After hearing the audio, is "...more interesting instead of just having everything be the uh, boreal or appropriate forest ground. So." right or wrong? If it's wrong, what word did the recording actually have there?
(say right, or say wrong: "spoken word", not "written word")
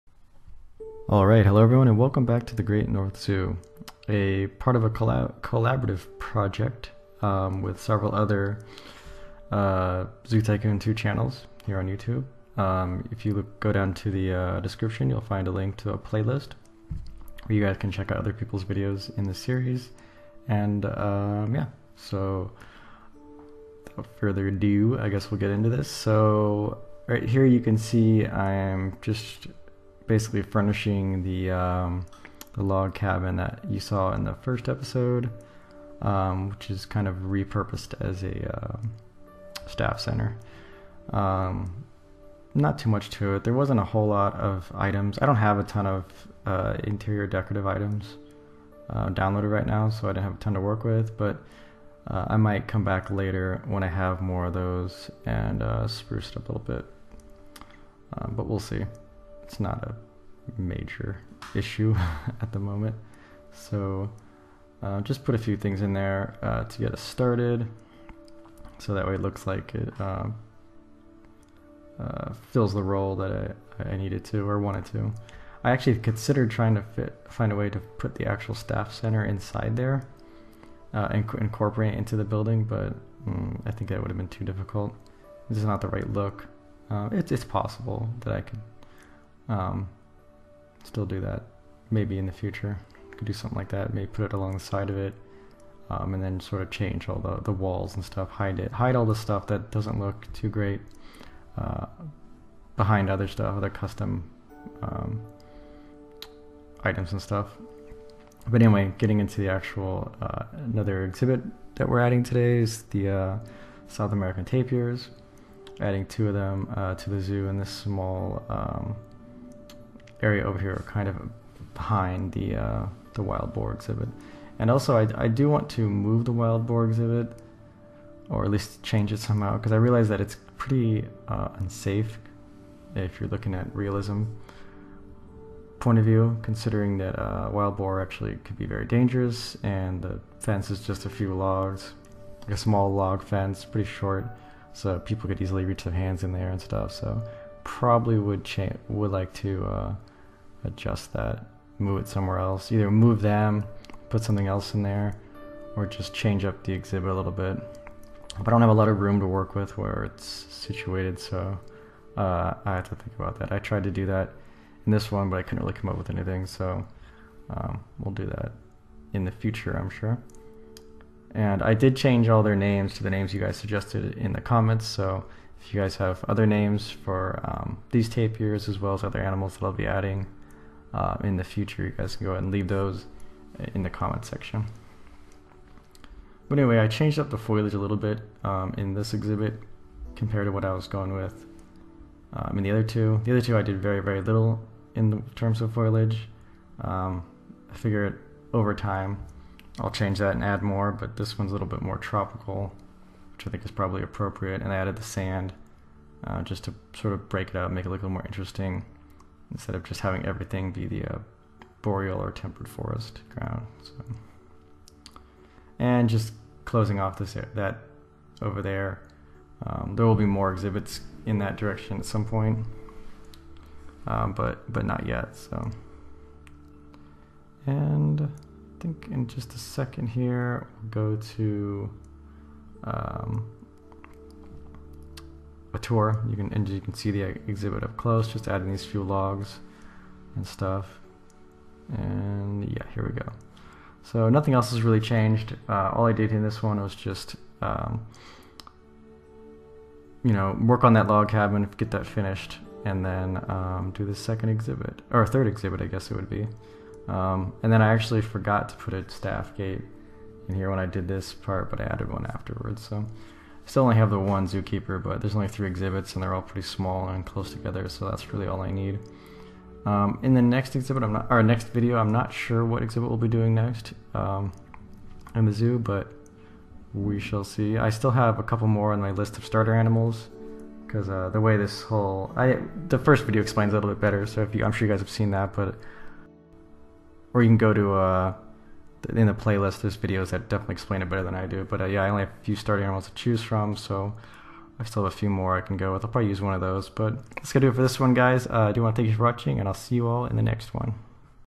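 wrong: "temperate", not "appropriate".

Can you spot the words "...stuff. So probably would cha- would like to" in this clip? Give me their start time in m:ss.
2:26.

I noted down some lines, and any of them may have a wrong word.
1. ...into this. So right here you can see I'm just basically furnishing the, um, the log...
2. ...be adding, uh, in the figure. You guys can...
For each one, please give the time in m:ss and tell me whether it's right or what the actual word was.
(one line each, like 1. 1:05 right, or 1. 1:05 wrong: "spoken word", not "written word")
1. 0:25 right
2. 2:59 wrong: "future", not "figure".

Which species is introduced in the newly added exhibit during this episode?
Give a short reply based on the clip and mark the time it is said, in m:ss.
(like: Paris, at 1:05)
South American tapirs, at 1:53.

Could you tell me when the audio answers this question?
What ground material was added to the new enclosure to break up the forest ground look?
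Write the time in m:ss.
3:25.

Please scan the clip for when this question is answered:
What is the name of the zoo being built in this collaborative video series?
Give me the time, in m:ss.
0:02.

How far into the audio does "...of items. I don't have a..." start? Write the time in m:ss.
0:44.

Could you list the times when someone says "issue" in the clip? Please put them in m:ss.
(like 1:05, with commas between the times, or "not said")
1:01.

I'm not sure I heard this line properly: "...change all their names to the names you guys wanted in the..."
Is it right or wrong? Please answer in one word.
wrong.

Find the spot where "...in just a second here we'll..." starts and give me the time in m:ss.
3:49.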